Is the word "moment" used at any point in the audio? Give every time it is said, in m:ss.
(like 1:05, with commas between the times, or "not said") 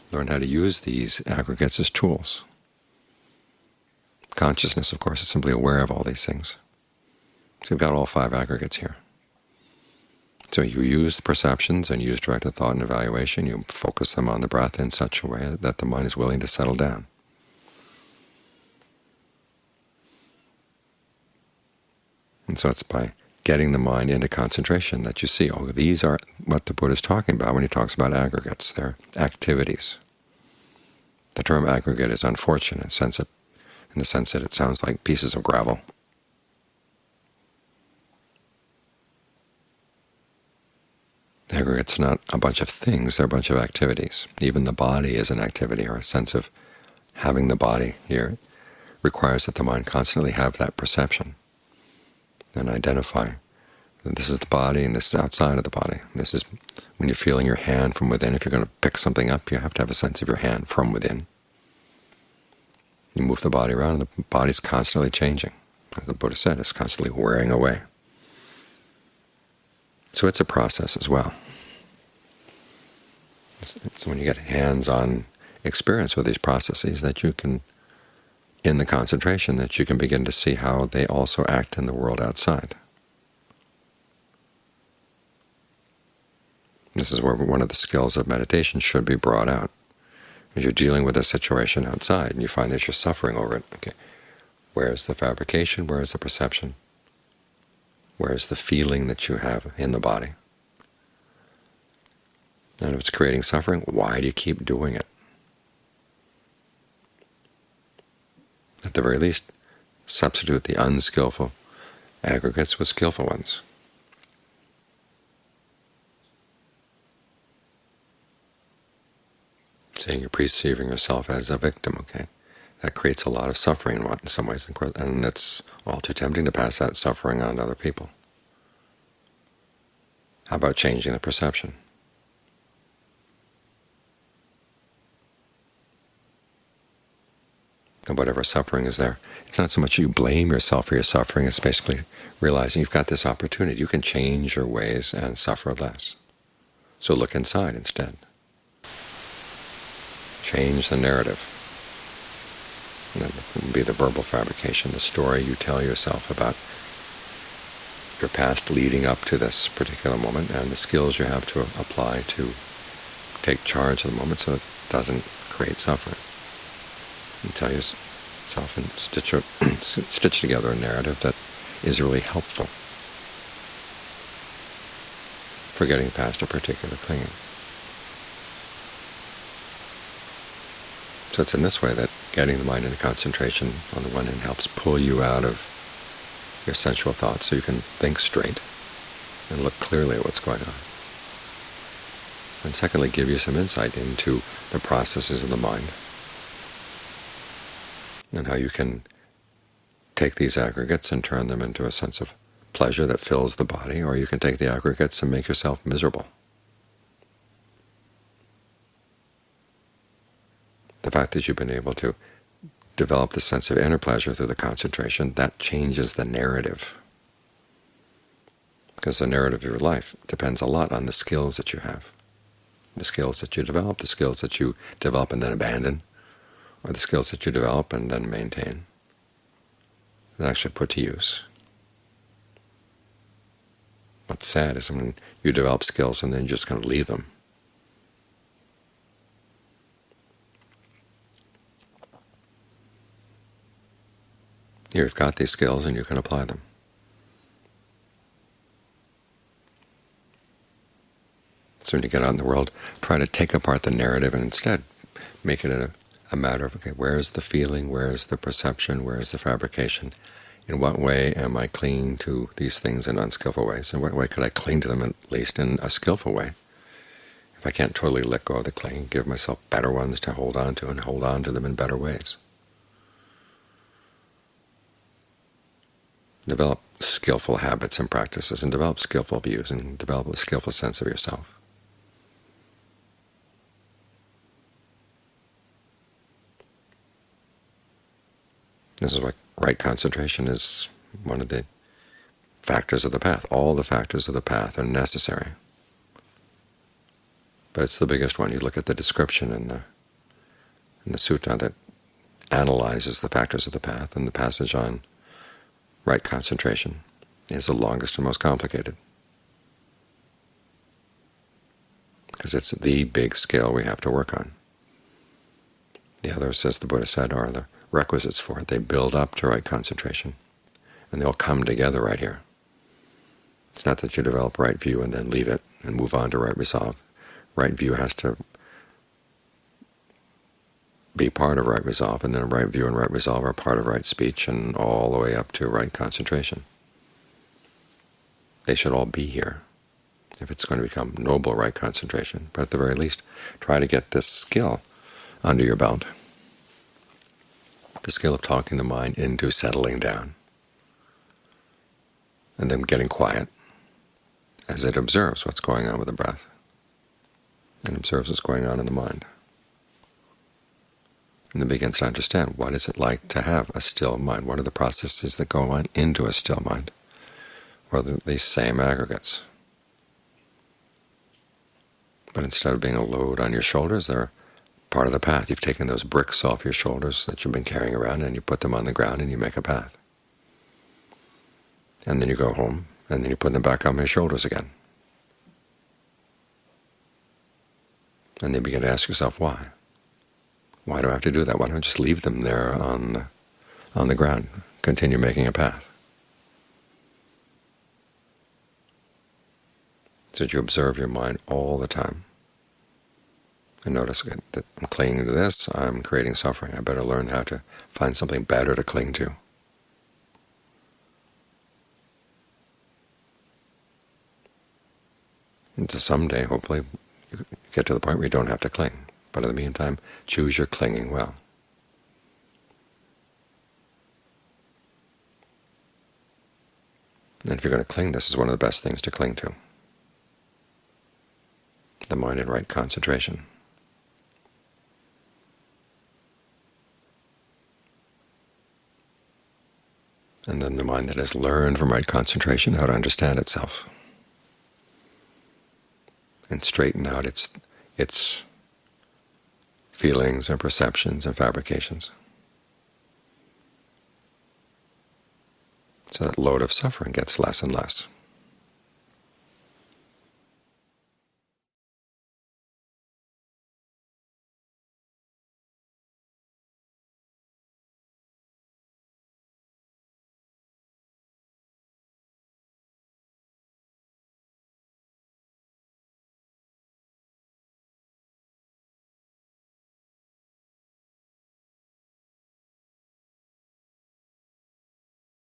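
2:40, 2:44.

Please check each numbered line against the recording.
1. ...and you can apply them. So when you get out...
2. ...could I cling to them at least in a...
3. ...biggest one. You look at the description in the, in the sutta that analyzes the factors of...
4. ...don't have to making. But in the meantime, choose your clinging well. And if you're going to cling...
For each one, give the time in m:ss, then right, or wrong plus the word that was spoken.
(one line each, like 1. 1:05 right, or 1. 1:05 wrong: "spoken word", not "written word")
1. 4:05 right
2. 4:24 right
3. 4:58 right
4. 6:58 wrong: "cling", not "making".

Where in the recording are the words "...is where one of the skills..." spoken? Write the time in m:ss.
1:27.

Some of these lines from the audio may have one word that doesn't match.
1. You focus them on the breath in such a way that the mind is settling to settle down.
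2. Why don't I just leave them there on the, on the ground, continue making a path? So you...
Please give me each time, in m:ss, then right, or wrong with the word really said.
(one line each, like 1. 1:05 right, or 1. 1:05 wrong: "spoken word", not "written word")
1. 0:13 wrong: "willing", not "settling"
2. 6:31 right.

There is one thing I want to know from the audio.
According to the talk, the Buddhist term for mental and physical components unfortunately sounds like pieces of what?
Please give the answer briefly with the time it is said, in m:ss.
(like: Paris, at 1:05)
gravel, at 0:35.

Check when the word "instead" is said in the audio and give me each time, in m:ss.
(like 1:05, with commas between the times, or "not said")
2:27, 4:14, 6:12.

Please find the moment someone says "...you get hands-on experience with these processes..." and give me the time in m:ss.
1:14.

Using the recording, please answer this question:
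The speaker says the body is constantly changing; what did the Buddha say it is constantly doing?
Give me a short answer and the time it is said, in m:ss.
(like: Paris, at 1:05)
wearing away, at 1:07.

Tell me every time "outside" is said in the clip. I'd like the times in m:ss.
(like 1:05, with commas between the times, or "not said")
0:55, 1:22, 1:31.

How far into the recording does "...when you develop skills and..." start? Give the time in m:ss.
3:54.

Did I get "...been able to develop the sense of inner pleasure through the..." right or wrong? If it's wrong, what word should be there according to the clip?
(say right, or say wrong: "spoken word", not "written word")
right.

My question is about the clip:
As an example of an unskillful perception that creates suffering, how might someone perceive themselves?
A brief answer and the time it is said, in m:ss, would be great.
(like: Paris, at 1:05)
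as a victim, at 2:01.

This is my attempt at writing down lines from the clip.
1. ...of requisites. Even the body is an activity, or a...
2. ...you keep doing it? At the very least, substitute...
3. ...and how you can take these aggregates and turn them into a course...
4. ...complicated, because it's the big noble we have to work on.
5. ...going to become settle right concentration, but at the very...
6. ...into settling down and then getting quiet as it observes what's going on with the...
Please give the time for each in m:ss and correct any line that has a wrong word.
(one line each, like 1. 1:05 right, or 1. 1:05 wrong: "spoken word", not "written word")
1. 0:43 wrong: "activities", not "requisites"
2. 1:44 right
3. 3:18 wrong: "sense", not "course"
4. 5:08 wrong: "scale", not "noble"
5. 5:40 wrong: "noble", not "settle"
6. 5:49 right.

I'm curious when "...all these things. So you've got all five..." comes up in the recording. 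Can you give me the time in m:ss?
0:05.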